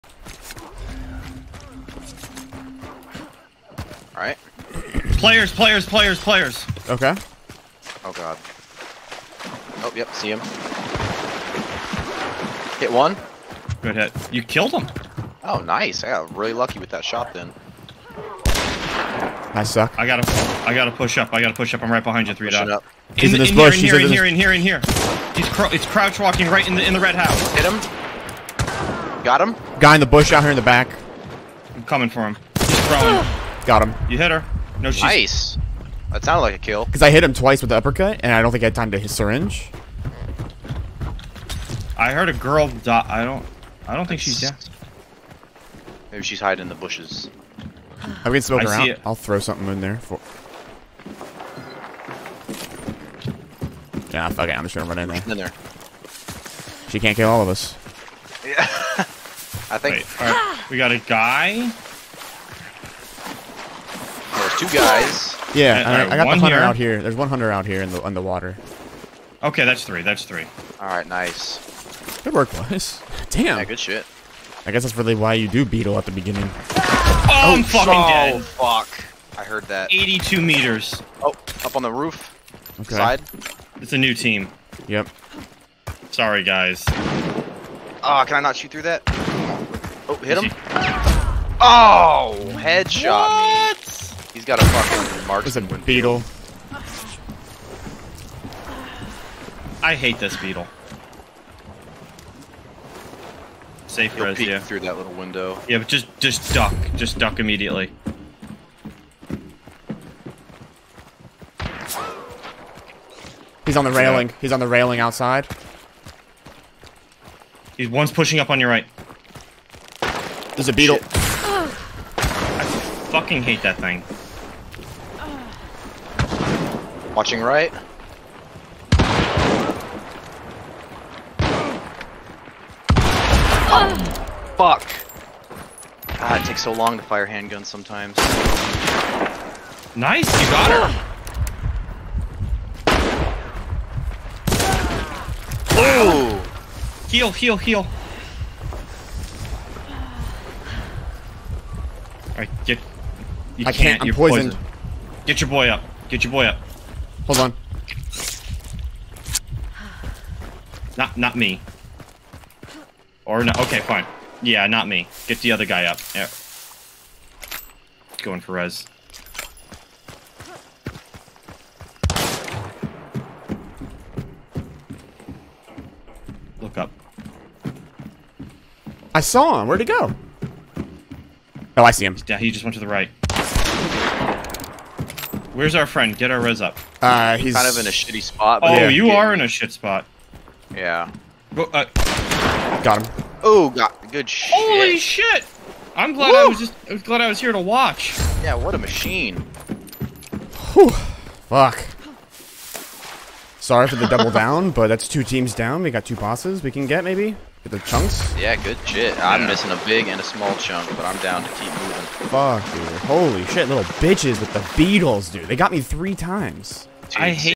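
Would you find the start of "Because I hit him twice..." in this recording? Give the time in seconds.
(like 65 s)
36 s.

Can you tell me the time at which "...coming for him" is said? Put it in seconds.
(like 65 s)
31 s.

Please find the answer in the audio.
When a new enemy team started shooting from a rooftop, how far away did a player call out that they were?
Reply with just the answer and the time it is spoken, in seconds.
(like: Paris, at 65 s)
82 meters, at 79 s.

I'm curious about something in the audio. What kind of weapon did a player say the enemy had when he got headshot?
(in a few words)
marksman.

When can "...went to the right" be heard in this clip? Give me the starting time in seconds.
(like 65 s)
182 s.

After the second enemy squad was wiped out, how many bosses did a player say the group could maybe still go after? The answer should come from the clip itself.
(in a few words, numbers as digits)
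2.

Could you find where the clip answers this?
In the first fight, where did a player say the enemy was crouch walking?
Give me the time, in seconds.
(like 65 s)
26 s.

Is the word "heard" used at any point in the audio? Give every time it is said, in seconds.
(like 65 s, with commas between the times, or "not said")
42 s, 79 s.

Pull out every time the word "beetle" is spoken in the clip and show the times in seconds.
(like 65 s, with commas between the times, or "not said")
75 s, 95 s, 100 s, 120 s, 214 s.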